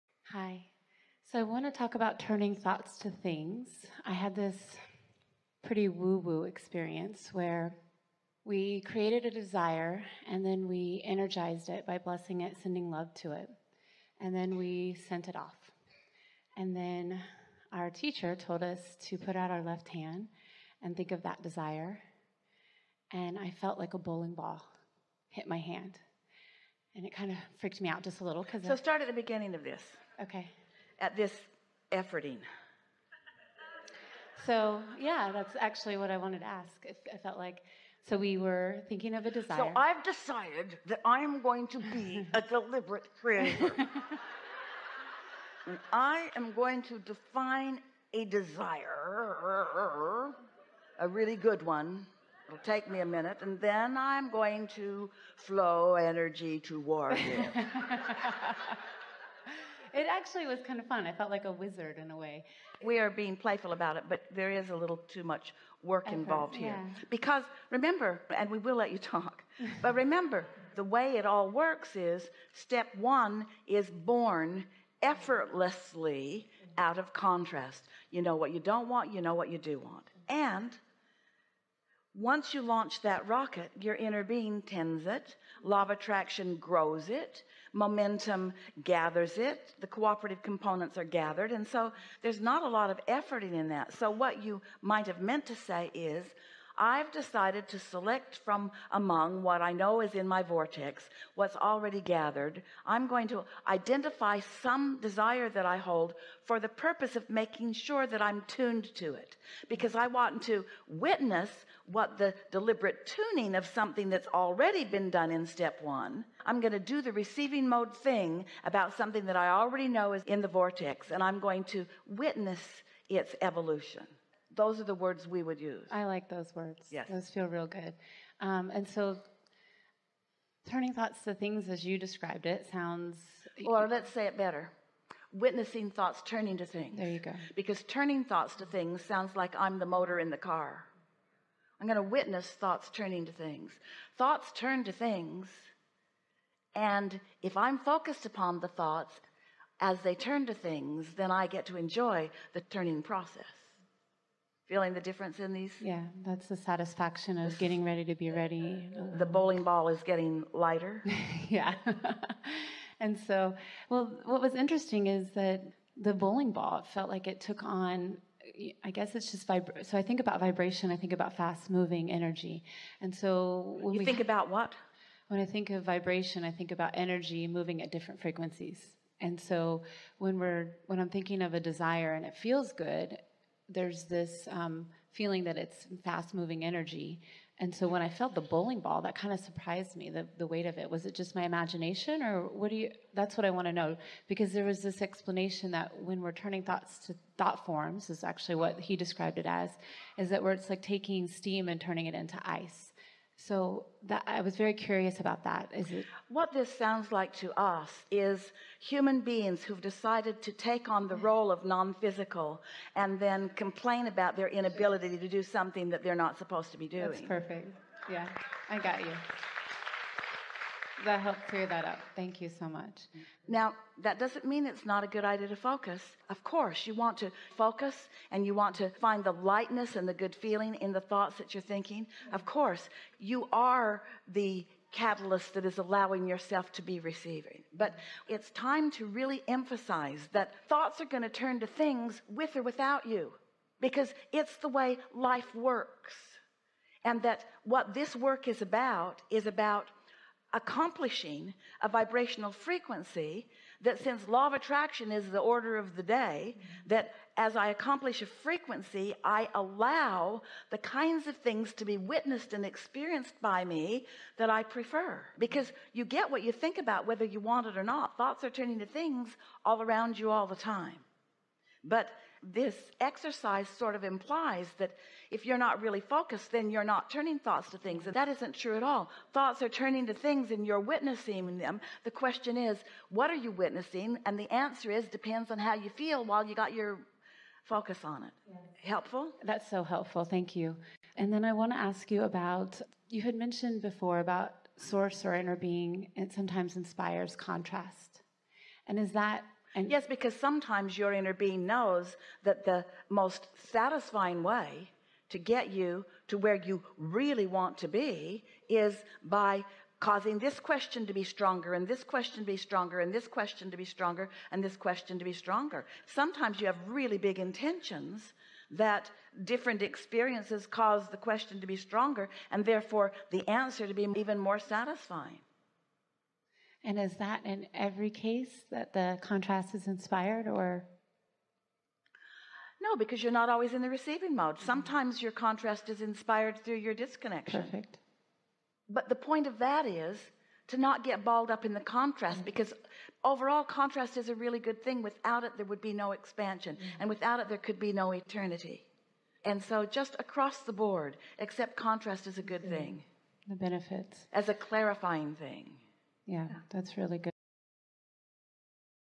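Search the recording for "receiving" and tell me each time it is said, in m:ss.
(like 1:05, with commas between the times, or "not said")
1:57, 3:56, 5:33.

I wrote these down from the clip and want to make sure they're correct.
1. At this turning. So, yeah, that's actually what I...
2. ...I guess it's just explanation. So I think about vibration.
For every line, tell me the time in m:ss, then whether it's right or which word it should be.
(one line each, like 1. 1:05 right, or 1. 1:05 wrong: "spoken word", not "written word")
1. 0:30 wrong: "efforting", not "turning"
2. 2:48 wrong: "vibration", not "explanation".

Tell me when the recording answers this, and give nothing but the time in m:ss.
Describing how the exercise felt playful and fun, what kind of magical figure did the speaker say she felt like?
1:01.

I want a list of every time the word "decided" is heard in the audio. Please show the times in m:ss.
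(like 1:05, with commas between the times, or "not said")
0:40, 1:37, 3:29.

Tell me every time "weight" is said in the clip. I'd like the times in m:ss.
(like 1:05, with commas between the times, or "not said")
3:10.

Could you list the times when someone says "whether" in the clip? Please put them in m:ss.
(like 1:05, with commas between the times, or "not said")
4:27.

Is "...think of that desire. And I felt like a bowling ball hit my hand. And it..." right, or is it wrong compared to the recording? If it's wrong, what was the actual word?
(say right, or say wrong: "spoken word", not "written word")
right.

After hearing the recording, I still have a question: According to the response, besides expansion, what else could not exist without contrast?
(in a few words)
Eternity.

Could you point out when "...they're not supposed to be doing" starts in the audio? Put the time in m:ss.
3:36.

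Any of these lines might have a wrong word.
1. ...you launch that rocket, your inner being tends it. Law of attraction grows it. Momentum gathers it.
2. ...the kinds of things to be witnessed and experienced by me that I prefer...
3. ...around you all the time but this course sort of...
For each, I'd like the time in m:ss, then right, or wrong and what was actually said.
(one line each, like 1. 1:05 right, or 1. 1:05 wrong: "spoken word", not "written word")
1. 1:22 right
2. 4:20 right
3. 4:29 wrong: "exercise", not "course".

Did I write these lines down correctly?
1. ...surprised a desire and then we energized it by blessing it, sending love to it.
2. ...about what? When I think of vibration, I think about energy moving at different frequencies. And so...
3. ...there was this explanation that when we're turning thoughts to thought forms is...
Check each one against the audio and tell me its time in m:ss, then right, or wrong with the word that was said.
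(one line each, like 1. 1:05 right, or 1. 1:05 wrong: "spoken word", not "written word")
1. 0:08 wrong: "created", not "surprised"
2. 2:54 right
3. 3:14 right.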